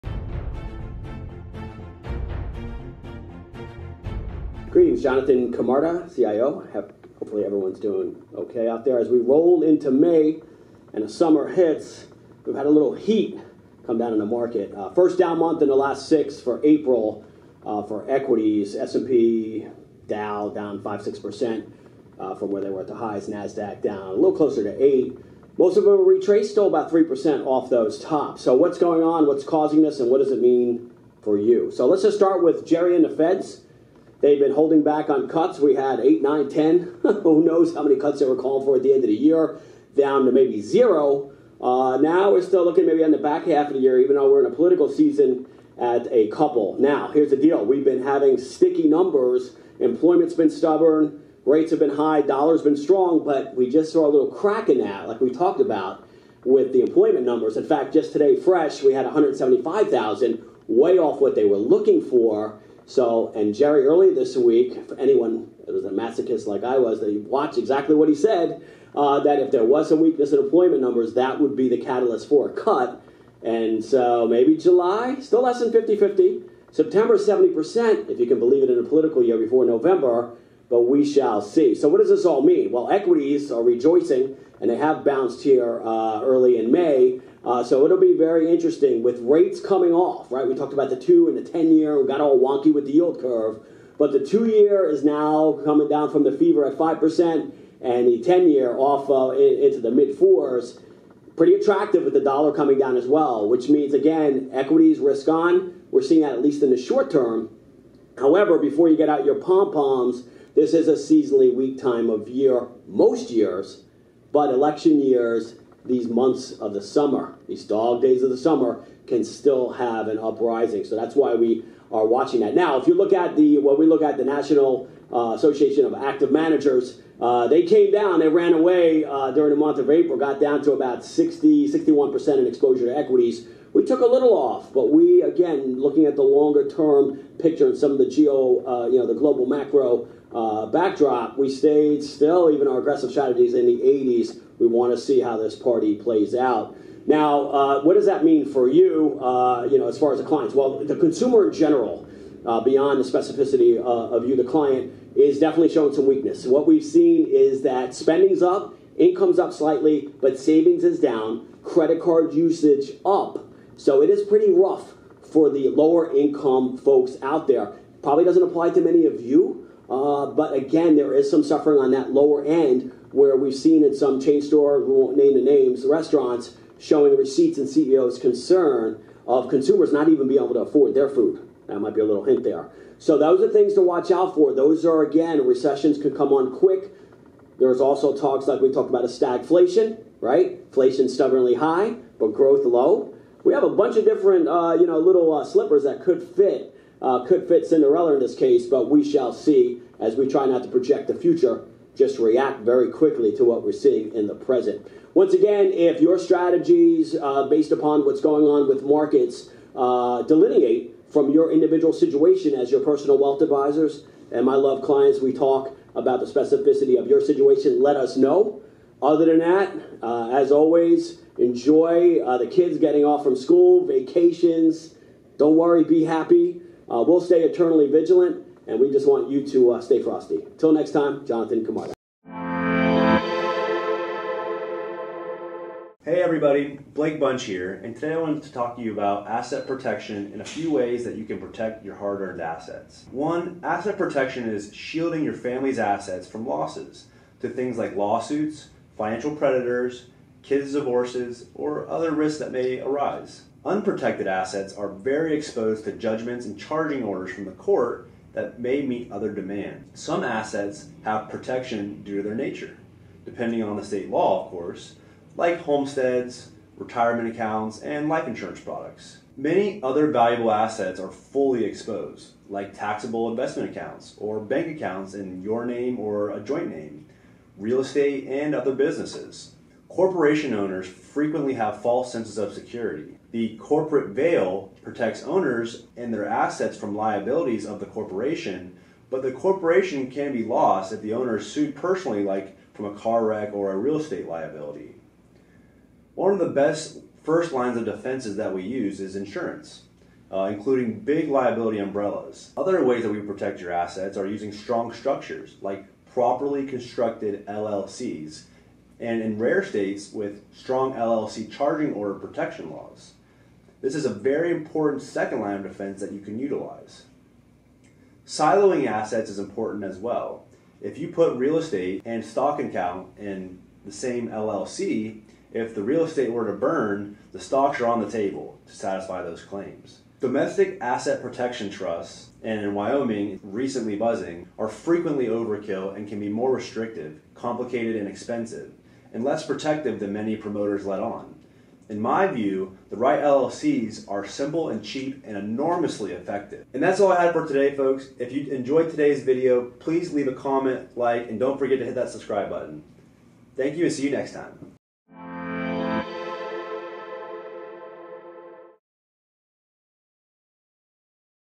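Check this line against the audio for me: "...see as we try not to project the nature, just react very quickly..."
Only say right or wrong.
wrong.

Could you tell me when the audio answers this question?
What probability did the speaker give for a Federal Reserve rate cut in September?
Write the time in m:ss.
1:17.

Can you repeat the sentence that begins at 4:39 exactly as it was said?
Corporation owners frequently have false senses of security.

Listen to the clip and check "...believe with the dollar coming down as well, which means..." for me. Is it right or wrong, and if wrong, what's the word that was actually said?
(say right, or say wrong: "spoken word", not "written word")
wrong: "attractive", not "believe".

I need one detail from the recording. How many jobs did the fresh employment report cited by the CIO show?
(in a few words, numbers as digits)
175,000.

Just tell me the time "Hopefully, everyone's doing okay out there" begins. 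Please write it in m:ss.
0:07.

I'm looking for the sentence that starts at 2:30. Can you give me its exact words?
Well, the consumer in general, uh, beyond the specificity uh, of you, the client, is definitely showing some weakness.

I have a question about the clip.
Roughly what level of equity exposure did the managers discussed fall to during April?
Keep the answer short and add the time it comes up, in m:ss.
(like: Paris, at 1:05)
60-61%, at 2:11.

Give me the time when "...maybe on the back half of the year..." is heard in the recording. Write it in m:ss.
0:42.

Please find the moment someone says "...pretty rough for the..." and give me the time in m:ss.
2:44.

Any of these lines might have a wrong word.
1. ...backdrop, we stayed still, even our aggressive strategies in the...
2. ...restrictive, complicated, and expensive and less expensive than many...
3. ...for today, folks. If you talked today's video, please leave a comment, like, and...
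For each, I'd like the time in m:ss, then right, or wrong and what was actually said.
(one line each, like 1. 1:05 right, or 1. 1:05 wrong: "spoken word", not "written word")
1. 2:20 right
2. 5:36 wrong: "protective", not "expensive"
3. 5:47 wrong: "enjoyed", not "talked".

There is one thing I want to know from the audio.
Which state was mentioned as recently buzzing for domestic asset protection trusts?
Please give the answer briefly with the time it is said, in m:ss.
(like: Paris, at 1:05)
Wyoming, at 5:32.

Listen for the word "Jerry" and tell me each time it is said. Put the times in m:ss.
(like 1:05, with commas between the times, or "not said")
0:32, 1:03.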